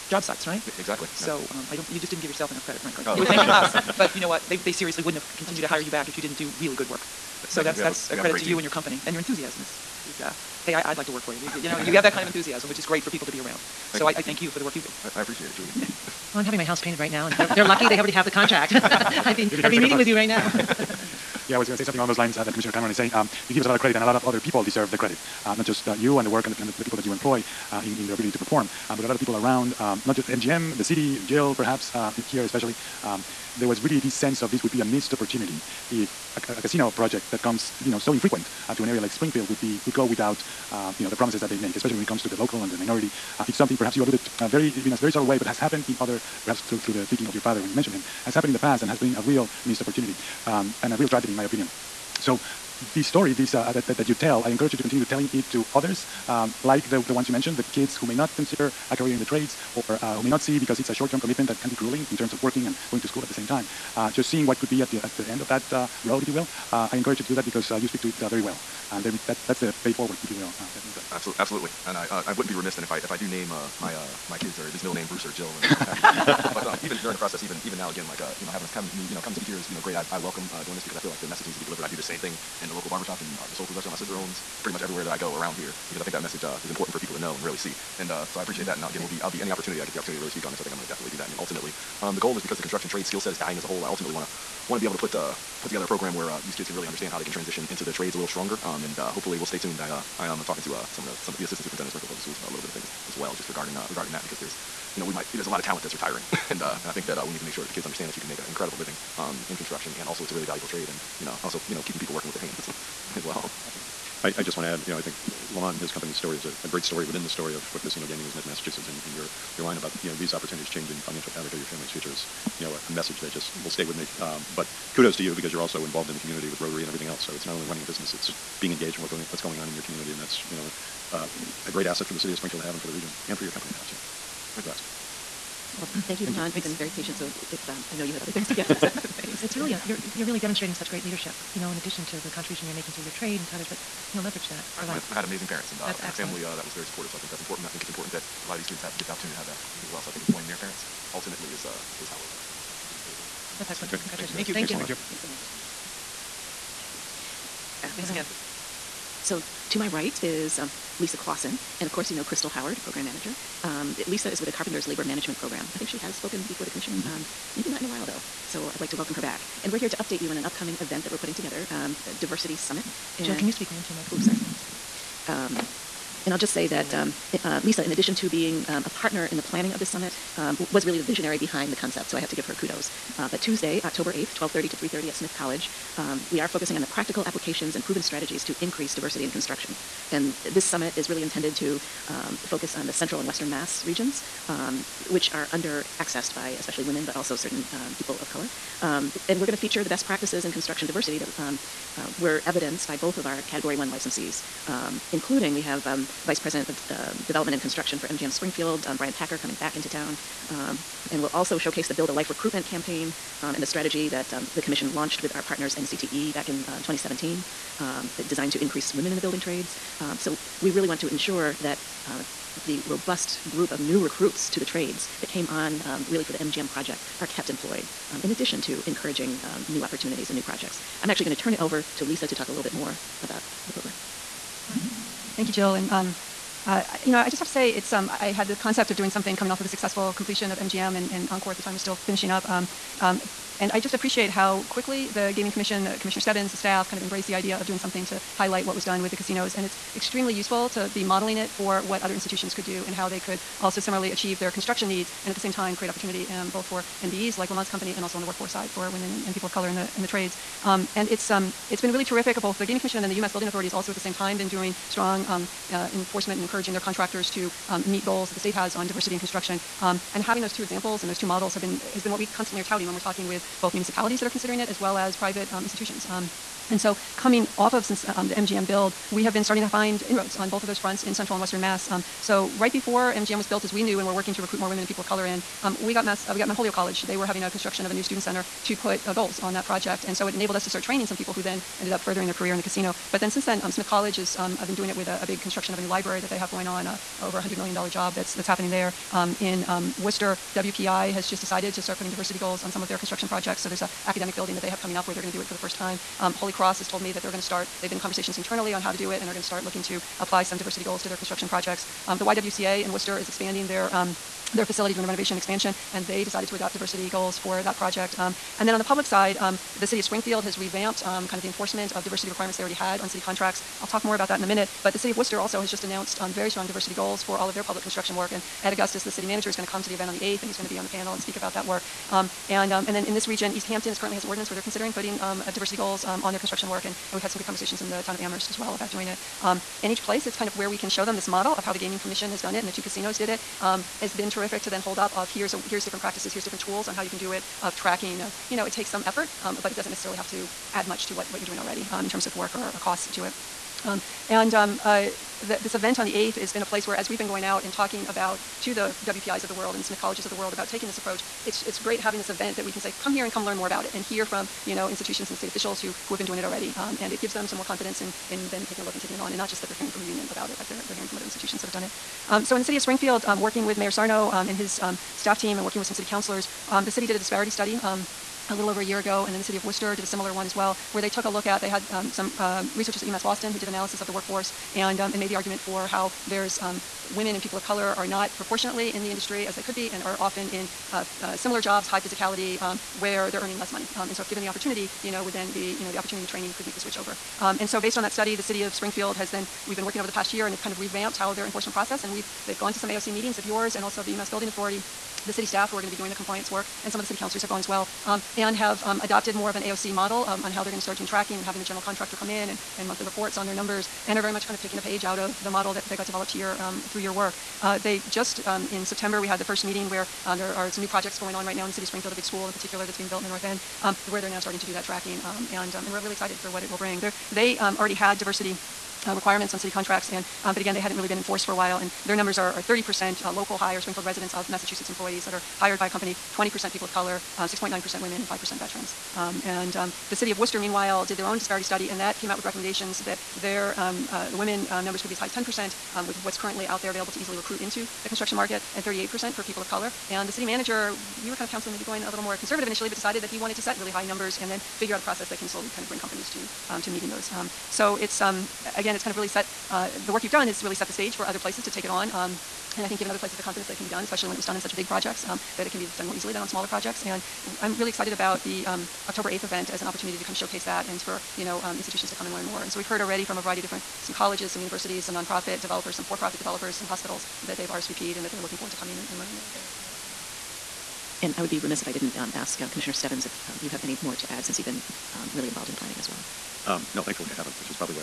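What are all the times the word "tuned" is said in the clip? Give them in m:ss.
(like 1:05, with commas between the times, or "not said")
1:39.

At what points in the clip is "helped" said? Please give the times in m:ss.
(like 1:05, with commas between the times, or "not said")
not said.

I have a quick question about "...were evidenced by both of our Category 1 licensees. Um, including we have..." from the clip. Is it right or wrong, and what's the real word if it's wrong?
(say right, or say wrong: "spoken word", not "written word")
right.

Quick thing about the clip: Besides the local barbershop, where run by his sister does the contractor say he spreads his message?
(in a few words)
soul food restaurant.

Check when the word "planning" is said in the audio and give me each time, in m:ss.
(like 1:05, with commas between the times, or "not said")
2:59, 8:05.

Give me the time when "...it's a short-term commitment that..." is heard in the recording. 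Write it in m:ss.
1:00.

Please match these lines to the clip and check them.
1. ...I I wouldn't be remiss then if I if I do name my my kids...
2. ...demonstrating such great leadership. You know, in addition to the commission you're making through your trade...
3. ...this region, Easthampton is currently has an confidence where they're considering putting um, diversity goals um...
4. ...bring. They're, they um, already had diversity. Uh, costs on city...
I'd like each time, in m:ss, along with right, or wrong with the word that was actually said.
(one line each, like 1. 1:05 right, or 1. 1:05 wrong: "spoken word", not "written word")
1. 1:11 right
2. 2:20 wrong: "contribution", not "commission"
3. 5:33 wrong: "ordinance", not "confidence"
4. 7:06 wrong: "requirements", not "costs".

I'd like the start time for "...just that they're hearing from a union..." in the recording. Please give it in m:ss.
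6:09.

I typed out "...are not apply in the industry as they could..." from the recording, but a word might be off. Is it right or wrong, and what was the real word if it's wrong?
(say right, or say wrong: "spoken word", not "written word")
wrong: "proportionately", not "apply".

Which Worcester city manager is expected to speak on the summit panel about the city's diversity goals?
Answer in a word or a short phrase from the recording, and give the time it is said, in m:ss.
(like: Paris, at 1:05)
Ed Augustus, at 5:28.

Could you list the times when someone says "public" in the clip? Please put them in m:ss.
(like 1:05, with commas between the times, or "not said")
1:42, 5:18, 5:27.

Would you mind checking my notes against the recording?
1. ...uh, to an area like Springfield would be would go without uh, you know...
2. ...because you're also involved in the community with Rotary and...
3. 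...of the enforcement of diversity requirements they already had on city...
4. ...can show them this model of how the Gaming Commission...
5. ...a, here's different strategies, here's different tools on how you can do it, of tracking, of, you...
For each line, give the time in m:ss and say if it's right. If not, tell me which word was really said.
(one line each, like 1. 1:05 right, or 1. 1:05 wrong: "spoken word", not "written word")
1. 0:38 right
2. 2:05 right
3. 5:21 right
4. 5:40 right
5. 5:45 wrong: "practices", not "strategies".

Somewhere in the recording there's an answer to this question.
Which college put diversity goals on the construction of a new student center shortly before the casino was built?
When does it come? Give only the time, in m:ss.
4:46.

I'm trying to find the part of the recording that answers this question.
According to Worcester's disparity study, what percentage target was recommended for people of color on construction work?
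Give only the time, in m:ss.
7:28.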